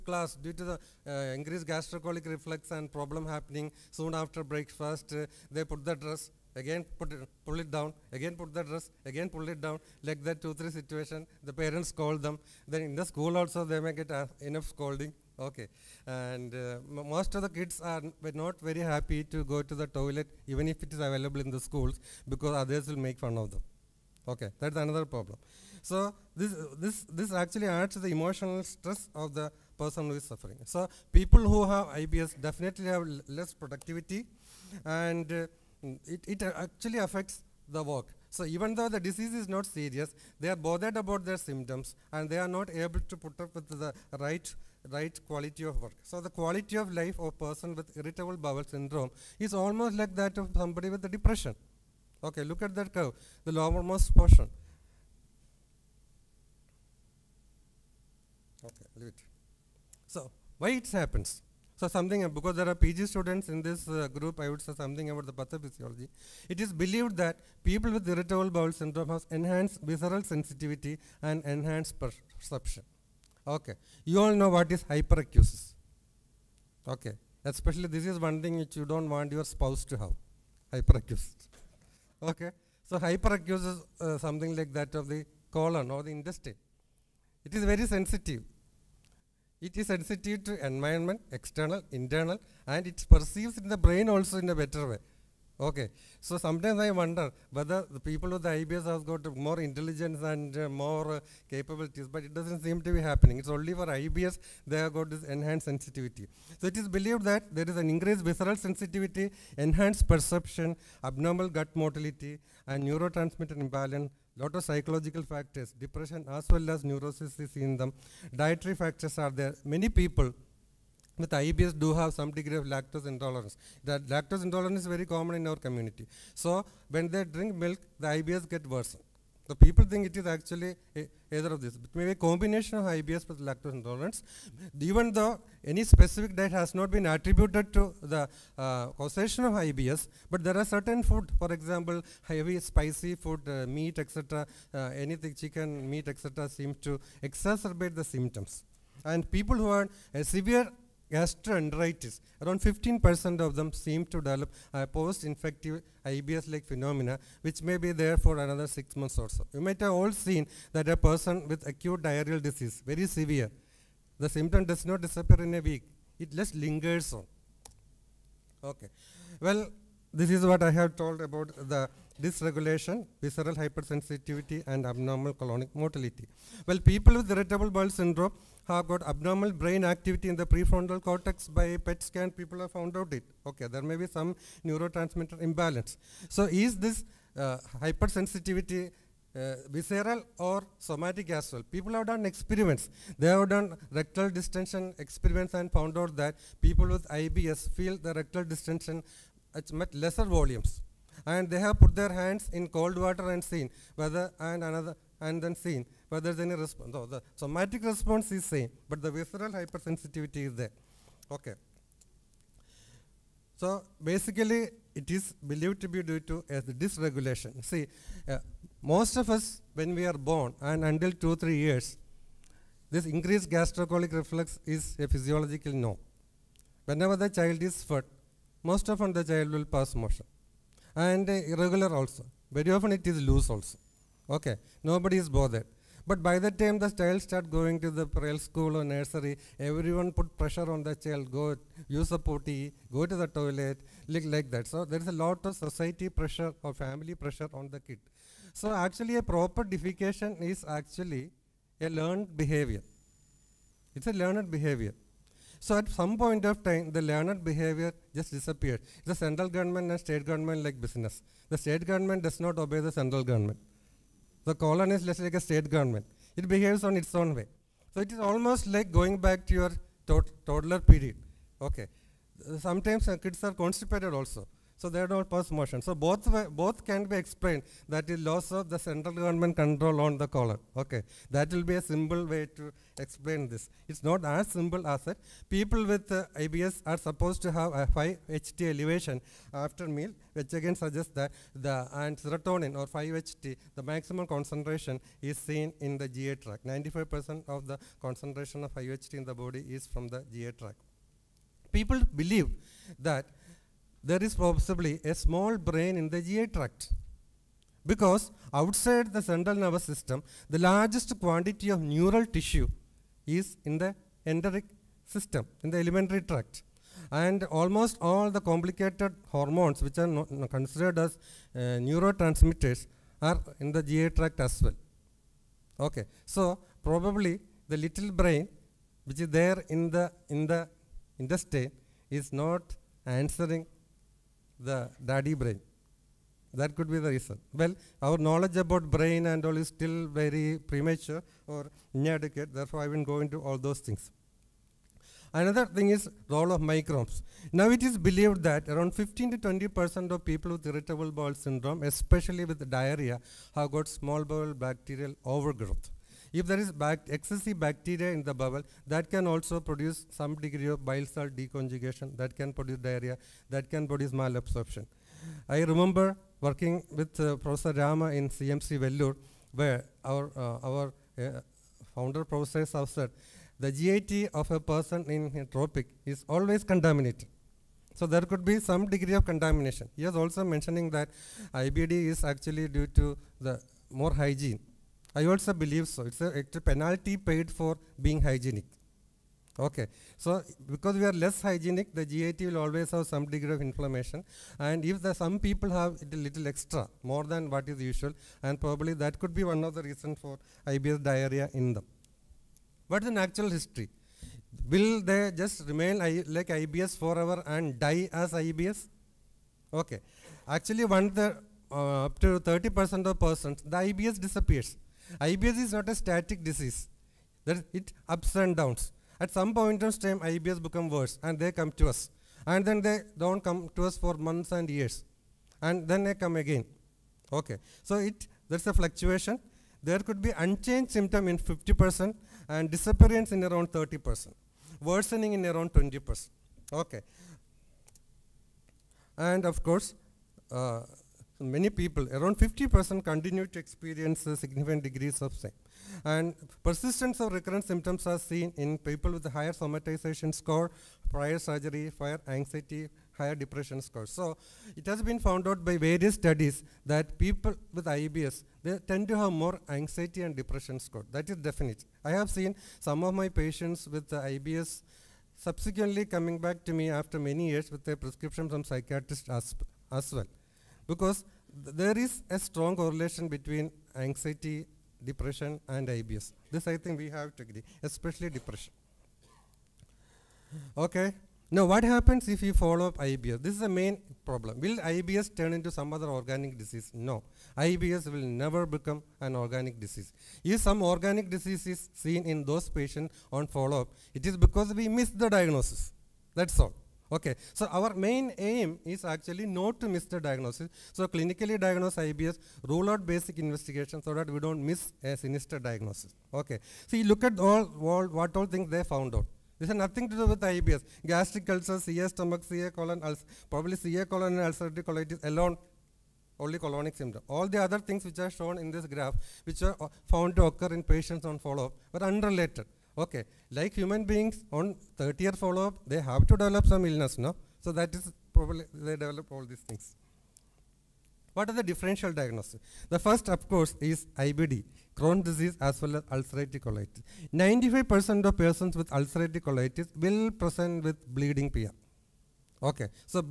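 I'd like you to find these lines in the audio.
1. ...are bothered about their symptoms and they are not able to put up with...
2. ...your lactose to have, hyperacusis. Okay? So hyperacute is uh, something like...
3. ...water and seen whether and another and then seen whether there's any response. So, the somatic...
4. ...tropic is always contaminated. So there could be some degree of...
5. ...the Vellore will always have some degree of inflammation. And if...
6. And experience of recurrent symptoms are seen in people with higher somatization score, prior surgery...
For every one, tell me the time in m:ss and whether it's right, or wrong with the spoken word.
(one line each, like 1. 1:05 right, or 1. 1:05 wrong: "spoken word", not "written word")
1. 0:40 right
2. 1:19 wrong: "spouse", not "lactose"
3. 3:23 right
4. 6:15 right
5. 6:31 wrong: "GIT", not "Vellore"
6. 7:26 wrong: "persistence", not "experience".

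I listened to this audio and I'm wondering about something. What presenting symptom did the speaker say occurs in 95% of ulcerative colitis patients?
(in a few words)
Bleeding PR.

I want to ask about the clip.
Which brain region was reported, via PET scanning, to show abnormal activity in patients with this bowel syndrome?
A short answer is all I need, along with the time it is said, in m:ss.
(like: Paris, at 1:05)
Prefrontal cortex, at 3:00.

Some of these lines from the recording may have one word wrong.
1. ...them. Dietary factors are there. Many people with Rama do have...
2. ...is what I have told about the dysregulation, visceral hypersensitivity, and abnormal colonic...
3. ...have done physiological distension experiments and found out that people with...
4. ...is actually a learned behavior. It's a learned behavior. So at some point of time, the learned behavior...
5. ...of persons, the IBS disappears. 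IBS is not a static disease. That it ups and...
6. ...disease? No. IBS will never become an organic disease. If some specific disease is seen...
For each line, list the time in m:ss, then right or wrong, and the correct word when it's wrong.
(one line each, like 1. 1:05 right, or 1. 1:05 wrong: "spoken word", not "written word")
1. 1:57 wrong: "IBS", not "Rama"
2. 2:50 right
3. 3:13 wrong: "rectal", not "physiological"
4. 4:10 right
5. 6:53 right
6. 8:06 wrong: "organic", not "specific".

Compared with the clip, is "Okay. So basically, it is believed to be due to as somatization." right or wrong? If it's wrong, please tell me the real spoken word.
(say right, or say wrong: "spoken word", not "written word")
wrong: "dysregulation", not "somatization".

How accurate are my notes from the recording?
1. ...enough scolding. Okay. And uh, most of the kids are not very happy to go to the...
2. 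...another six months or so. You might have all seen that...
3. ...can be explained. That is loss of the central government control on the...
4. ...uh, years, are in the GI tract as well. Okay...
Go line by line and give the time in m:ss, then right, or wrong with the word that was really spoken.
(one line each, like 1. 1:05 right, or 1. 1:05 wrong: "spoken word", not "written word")
1. 0:14 right
2. 2:38 right
3. 4:36 right
4. 5:21 wrong: "neurotransmitters", not "years".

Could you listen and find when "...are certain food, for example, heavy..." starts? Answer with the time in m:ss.
2:20.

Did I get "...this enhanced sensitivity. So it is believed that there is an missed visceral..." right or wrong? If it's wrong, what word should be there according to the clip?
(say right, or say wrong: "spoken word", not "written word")
wrong: "increased", not "missed".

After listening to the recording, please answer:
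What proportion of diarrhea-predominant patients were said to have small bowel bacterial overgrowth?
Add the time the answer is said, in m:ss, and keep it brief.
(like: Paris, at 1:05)
15 to 20 percent, at 5:48.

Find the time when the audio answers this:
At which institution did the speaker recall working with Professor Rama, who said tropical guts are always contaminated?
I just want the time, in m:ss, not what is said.
6:08.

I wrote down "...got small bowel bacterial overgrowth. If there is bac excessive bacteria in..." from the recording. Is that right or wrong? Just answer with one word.
right.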